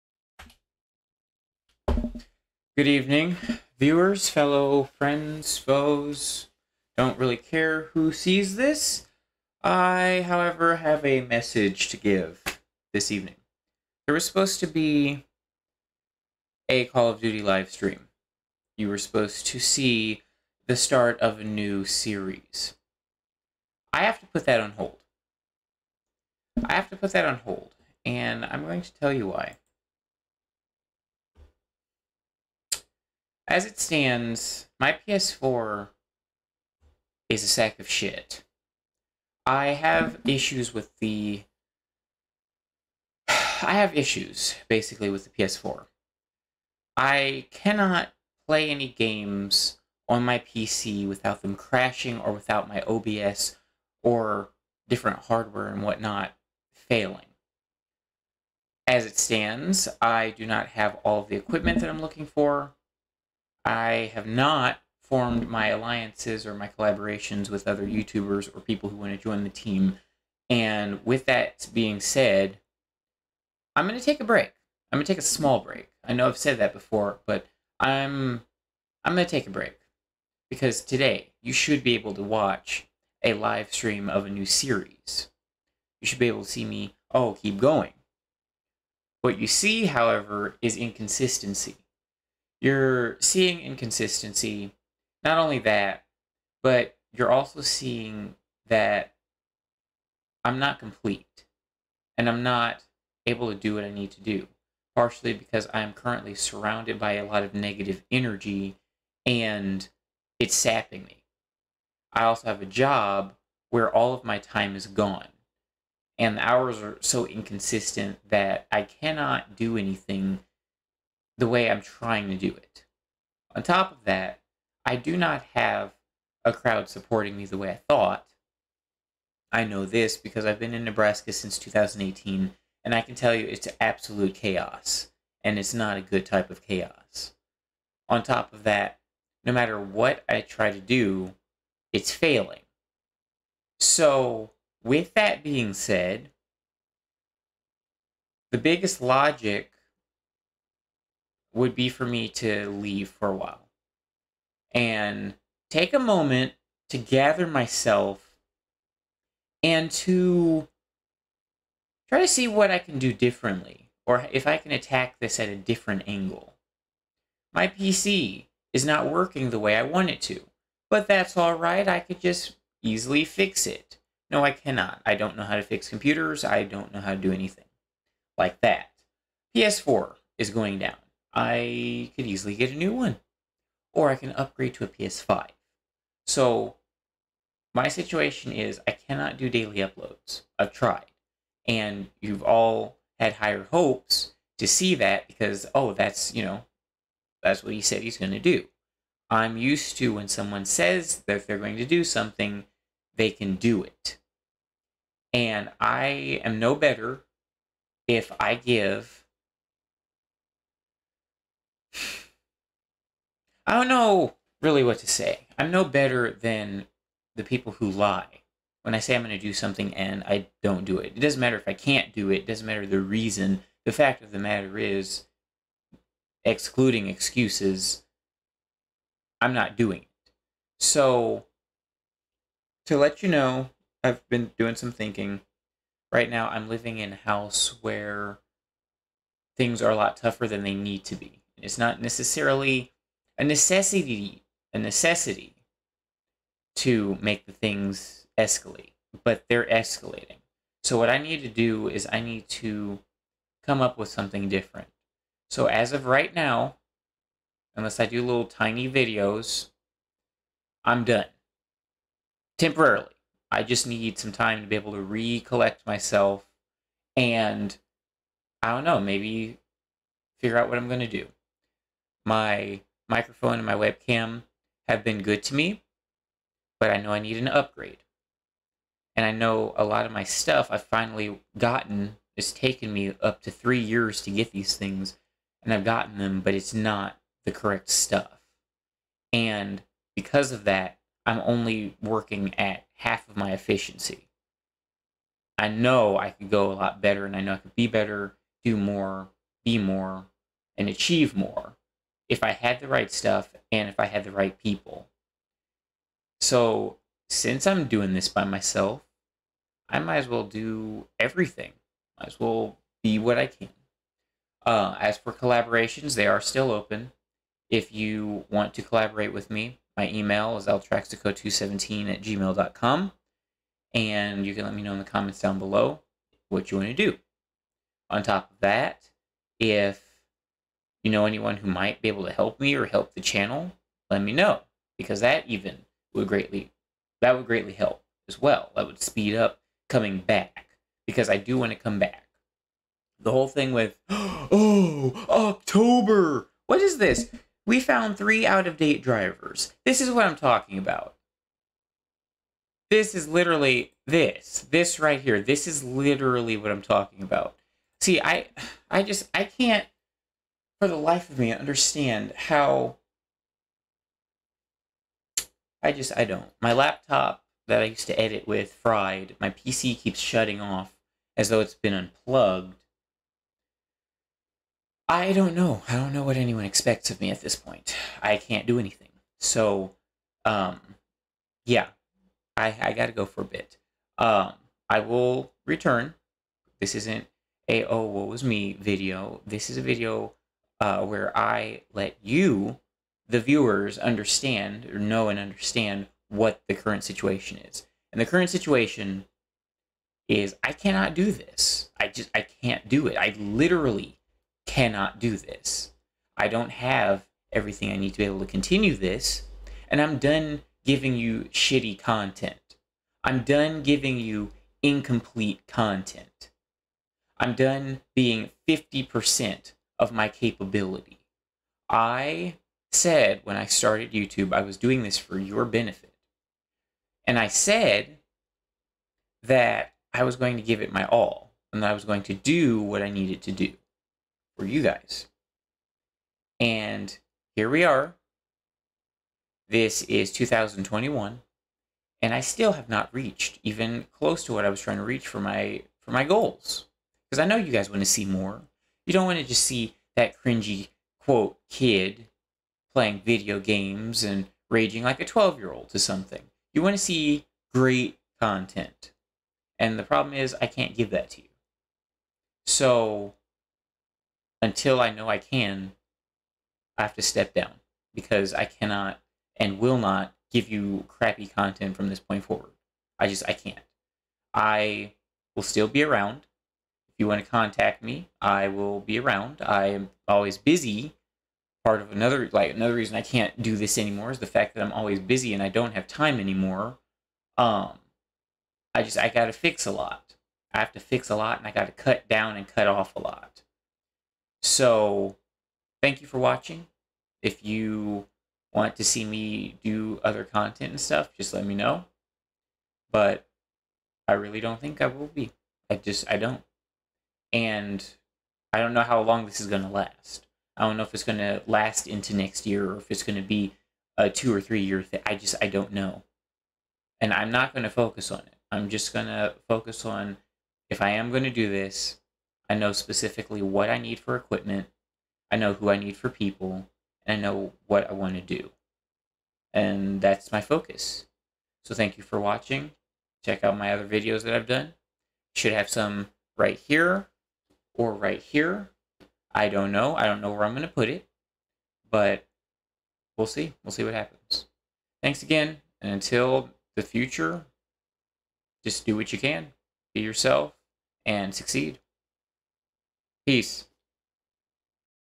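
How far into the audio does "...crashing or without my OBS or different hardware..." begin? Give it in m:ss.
0:51.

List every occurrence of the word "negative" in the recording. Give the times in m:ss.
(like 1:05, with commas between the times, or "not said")
1:47.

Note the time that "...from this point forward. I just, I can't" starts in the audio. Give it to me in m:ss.
7:51.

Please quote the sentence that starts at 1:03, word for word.
I have not formed my alliances or my collaborations with other YouTubers or people who want to join the team.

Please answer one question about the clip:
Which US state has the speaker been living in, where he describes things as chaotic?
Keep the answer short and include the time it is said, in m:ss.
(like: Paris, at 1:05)
Nebraska, at 2:10.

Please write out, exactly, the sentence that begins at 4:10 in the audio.
So what I need to do is I need to come up with something different.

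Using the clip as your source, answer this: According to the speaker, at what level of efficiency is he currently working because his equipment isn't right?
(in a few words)
half.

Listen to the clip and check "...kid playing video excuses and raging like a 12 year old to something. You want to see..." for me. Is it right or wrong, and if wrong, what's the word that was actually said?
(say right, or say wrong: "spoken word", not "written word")
wrong: "games", not "excuses".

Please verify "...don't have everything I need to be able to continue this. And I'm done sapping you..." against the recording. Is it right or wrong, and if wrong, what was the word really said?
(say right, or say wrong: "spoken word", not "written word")
wrong: "giving", not "sapping".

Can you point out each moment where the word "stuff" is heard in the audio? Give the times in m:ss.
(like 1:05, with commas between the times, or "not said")
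4:40, 4:47, 5:03, 8:20.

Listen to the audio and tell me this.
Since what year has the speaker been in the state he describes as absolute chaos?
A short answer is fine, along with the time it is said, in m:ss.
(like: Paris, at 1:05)
2018, at 2:11.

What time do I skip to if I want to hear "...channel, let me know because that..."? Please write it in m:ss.
5:33.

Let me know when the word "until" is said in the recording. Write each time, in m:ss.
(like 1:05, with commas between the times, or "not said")
7:44, 9:06.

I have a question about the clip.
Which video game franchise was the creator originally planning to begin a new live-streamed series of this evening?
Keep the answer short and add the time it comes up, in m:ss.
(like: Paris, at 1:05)
Call of Duty, at 0:16.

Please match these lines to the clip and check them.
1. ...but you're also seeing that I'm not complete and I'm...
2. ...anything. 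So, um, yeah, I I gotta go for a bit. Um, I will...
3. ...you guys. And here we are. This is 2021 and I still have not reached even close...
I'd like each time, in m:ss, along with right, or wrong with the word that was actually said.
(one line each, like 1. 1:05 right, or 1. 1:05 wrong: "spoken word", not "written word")
1. 1:36 right
2. 6:18 right
3. 7:14 right.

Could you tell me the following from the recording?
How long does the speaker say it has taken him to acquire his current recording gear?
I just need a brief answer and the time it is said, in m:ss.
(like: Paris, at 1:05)
three years, at 4:43.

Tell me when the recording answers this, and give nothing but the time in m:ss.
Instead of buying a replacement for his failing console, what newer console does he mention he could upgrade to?
3:04.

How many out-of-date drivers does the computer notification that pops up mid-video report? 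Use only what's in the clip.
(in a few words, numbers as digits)
3.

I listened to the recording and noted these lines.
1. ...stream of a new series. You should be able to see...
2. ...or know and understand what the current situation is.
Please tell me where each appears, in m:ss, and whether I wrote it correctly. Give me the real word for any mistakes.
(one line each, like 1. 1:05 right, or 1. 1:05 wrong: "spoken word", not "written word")
1. 1:23 right
2. 6:34 right.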